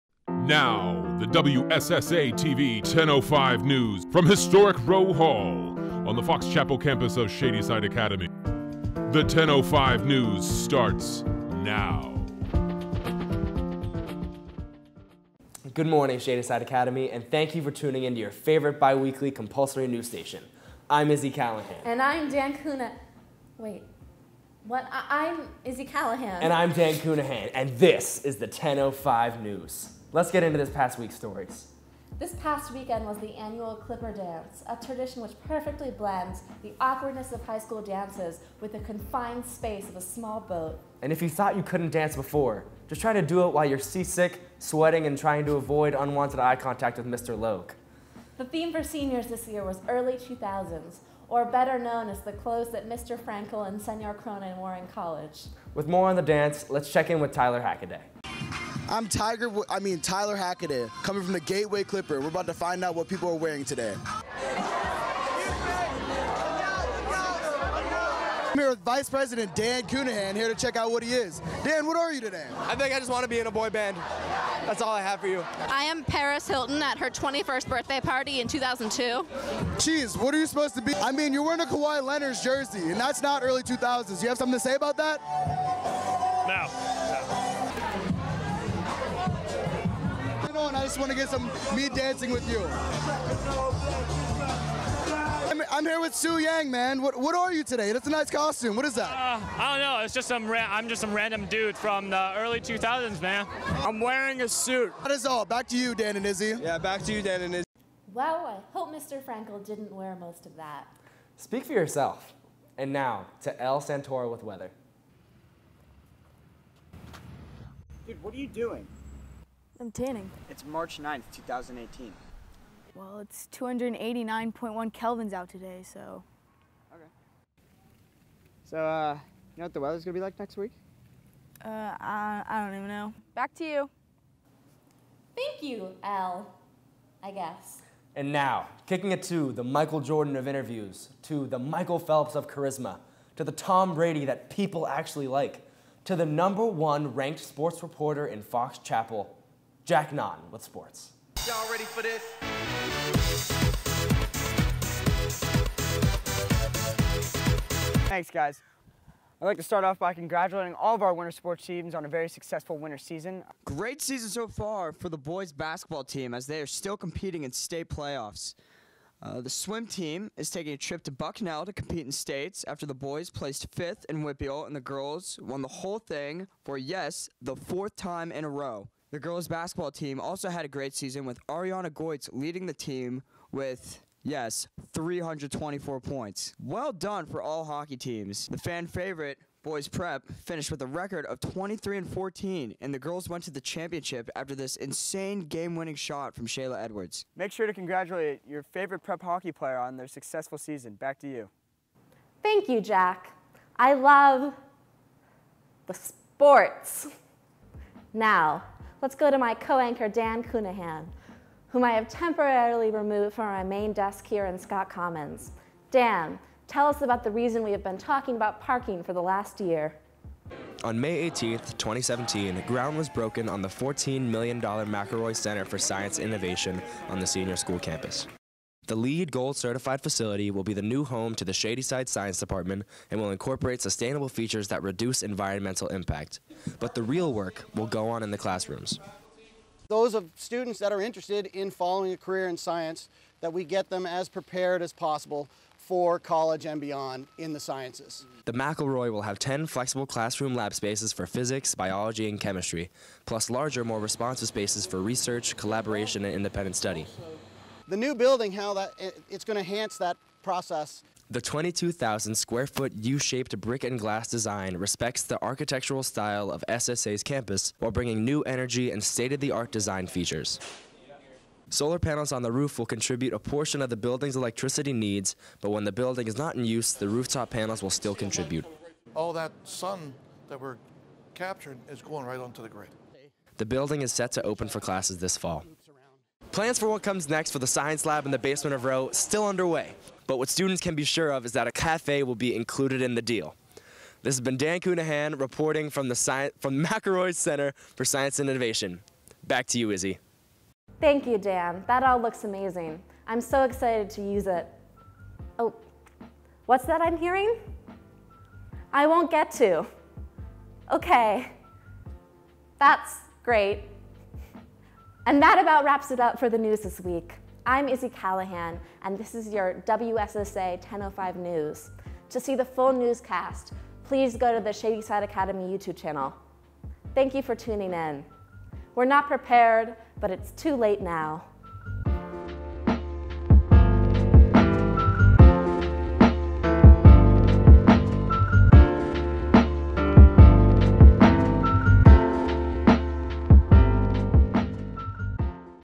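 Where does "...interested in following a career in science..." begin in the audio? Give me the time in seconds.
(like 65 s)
241 s.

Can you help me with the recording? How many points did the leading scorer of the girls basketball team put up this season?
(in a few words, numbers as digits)
324.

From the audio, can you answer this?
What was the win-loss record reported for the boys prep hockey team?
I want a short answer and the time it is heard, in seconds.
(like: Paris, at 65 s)
23 and 14, at 191 s.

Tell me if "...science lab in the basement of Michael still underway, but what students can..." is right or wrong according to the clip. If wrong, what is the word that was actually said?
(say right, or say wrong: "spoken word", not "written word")
wrong: "Roe", not "Michael".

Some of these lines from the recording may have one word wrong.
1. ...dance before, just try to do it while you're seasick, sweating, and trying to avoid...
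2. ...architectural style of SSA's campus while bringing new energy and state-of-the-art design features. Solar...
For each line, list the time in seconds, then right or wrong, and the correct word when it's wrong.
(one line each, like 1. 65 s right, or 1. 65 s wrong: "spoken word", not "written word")
1. 41 s right
2. 265 s right.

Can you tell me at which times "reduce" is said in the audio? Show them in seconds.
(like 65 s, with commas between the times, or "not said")
234 s.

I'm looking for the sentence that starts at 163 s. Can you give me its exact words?
Great season so far for the boys basketball team as they are still competing in state playoffs.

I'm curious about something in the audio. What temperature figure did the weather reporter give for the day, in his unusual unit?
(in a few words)
289.1 kelvins.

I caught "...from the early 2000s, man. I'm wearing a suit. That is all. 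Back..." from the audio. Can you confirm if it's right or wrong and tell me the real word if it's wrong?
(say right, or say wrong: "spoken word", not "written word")
right.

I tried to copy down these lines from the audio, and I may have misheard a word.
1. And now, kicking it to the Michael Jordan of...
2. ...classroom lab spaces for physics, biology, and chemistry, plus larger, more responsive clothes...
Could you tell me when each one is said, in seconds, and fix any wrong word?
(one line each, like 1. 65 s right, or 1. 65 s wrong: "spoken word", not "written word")
1. 138 s right
2. 250 s wrong: "spaces", not "clothes".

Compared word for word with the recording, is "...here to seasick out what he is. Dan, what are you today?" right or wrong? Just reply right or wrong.
wrong.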